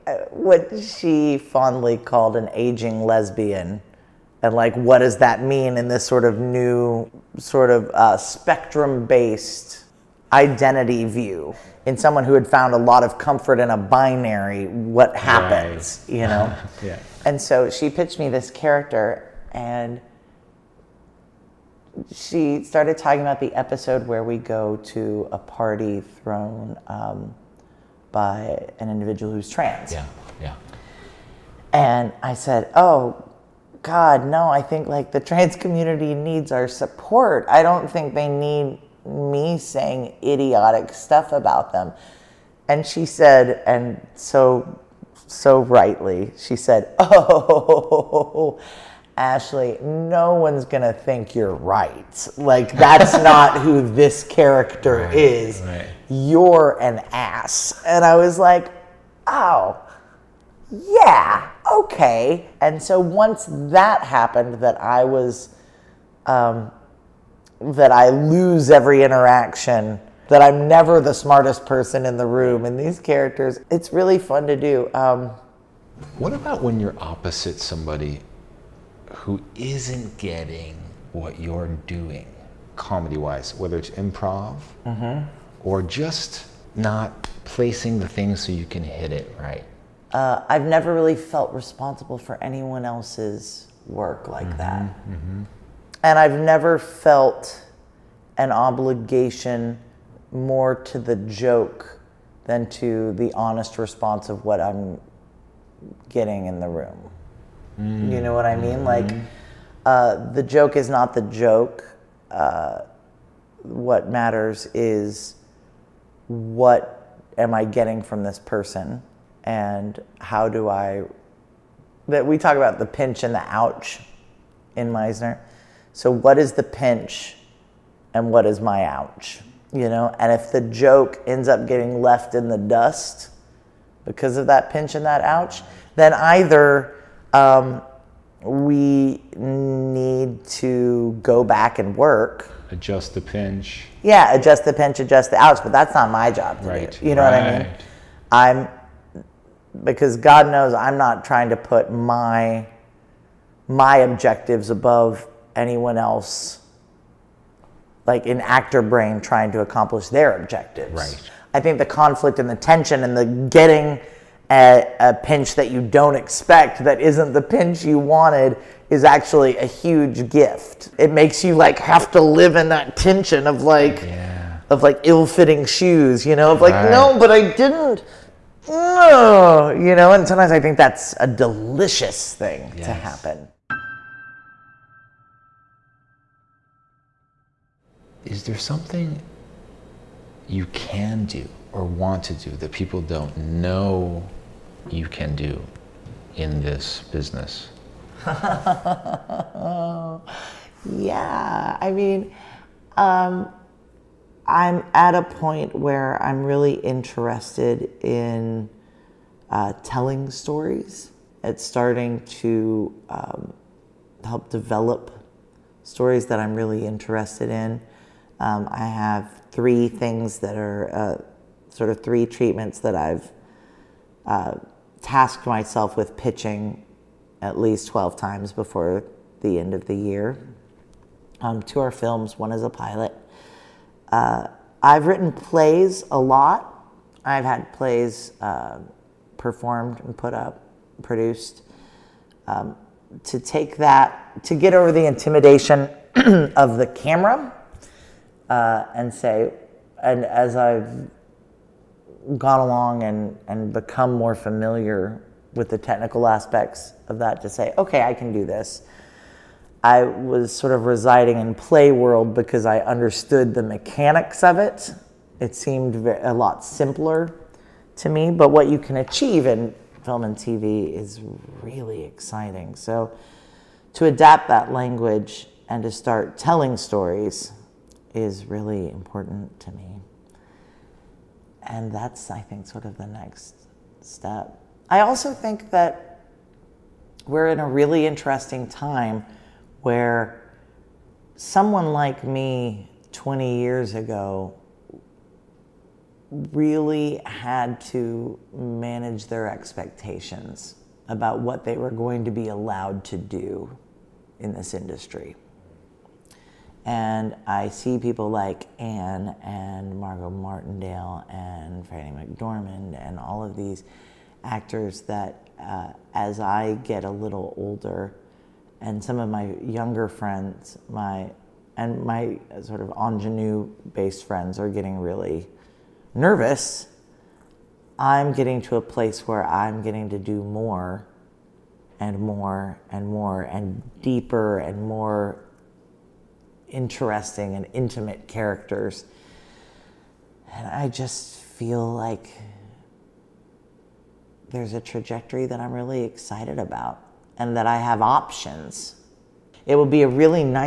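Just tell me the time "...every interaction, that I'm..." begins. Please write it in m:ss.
1:08.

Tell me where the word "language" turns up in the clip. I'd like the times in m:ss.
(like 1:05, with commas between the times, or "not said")
4:34.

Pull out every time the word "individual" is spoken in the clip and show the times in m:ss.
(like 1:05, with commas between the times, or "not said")
0:28.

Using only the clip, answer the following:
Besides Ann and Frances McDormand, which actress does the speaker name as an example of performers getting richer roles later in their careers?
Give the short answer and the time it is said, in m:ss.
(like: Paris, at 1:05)
Margot Martindale, at 5:09.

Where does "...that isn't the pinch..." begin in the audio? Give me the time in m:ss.
2:46.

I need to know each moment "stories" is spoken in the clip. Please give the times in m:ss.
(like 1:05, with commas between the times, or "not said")
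3:30, 3:35, 4:36.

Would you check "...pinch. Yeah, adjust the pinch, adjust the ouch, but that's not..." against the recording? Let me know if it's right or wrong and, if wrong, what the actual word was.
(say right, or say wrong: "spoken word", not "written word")
right.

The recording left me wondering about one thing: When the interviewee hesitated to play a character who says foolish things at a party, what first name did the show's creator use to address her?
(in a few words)
Ashlie.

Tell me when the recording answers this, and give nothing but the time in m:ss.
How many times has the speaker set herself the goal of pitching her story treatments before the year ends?
3:47.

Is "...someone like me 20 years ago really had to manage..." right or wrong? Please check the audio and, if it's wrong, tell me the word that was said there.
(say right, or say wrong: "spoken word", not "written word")
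right.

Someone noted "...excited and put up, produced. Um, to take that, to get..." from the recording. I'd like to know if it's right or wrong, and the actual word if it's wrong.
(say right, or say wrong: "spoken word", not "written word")
wrong: "performed", not "excited".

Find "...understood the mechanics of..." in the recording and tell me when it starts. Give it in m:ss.
4:22.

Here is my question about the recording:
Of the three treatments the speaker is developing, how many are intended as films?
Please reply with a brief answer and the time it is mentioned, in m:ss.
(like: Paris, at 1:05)
2, at 3:51.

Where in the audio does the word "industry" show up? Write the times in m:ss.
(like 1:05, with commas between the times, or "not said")
5:04.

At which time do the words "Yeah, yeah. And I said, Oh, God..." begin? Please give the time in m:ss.
0:29.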